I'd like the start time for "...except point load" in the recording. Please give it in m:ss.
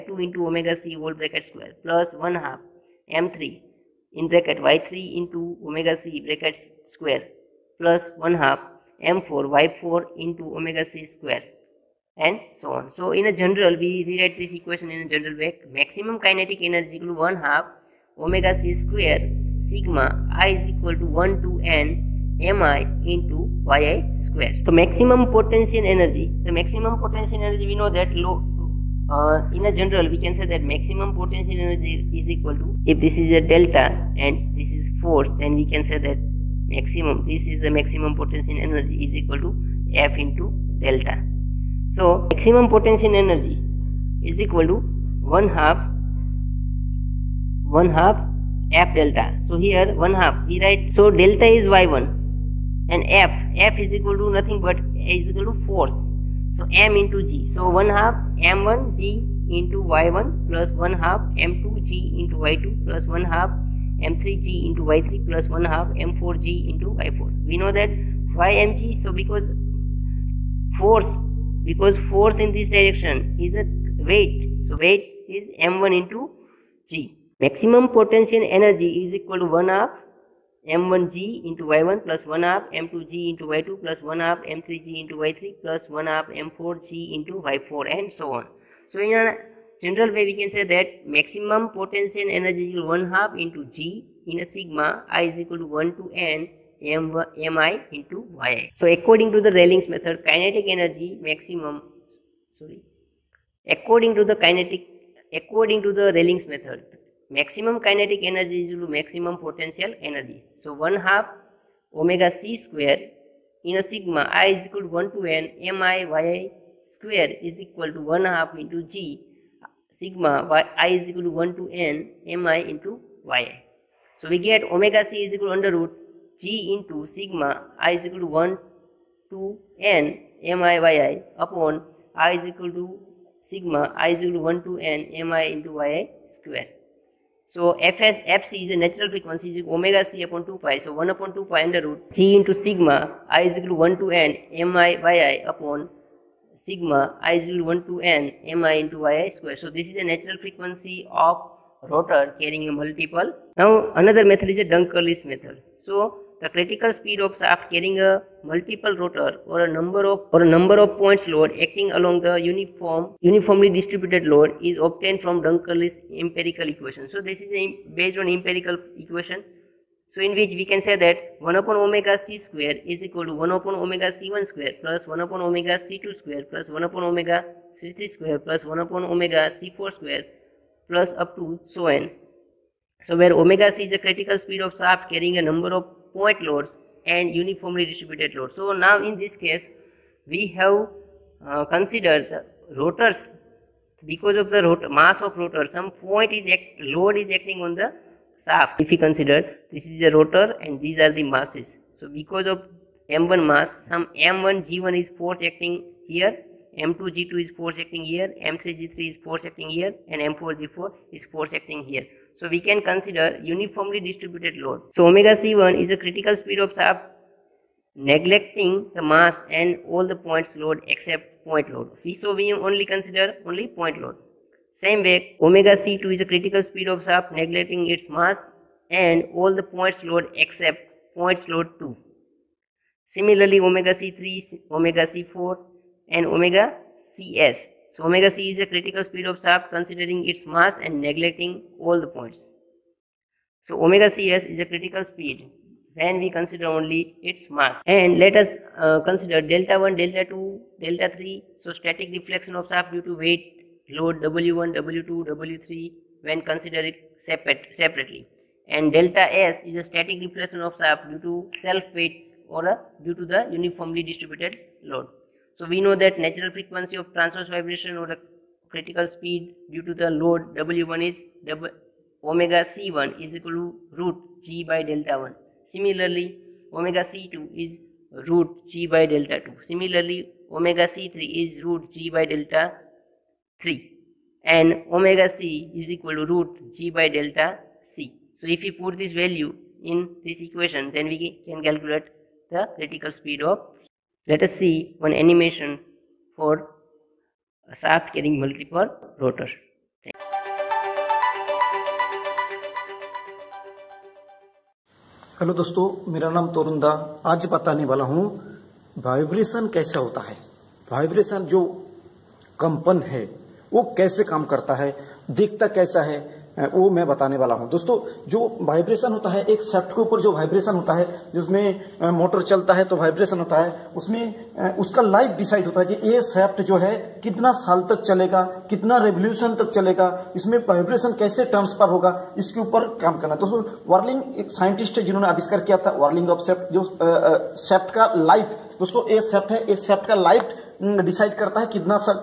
3:40.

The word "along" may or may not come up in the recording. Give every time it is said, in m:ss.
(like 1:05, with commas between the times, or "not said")
2:41.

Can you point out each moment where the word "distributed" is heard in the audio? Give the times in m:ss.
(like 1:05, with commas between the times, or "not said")
2:43, 3:07, 3:34, 4:24.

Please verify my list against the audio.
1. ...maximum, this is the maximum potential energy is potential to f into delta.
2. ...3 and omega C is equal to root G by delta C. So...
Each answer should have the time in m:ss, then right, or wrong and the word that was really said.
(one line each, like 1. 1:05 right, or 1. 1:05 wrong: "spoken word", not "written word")
1. 0:36 wrong: "equal", not "potential"
2. 4:43 right.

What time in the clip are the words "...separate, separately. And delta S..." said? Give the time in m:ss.
4:17.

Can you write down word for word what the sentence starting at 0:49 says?
So here one half we write so delta is y1 and f f is equal to nothing but is equal to force.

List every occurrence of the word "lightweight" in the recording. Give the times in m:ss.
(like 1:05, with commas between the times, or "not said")
not said.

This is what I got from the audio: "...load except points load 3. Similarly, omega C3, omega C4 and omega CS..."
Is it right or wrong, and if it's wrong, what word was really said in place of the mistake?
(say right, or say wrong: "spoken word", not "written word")
wrong: "2", not "3".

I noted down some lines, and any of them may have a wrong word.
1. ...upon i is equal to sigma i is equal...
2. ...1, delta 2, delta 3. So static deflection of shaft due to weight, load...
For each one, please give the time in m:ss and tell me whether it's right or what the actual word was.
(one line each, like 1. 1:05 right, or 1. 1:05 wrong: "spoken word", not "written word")
1. 2:11 right
2. 4:09 right.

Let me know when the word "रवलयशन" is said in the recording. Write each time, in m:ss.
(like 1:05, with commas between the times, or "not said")
5:29.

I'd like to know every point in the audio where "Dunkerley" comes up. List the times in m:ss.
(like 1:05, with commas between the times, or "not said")
2:34, 2:45.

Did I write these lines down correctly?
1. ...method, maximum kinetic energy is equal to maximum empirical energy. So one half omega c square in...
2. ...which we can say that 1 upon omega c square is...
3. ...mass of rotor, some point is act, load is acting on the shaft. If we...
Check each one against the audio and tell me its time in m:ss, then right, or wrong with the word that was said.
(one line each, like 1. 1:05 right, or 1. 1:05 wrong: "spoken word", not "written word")
1. 1:46 wrong: "potential", not "empirical"
2. 2:50 right
3. 3:14 right.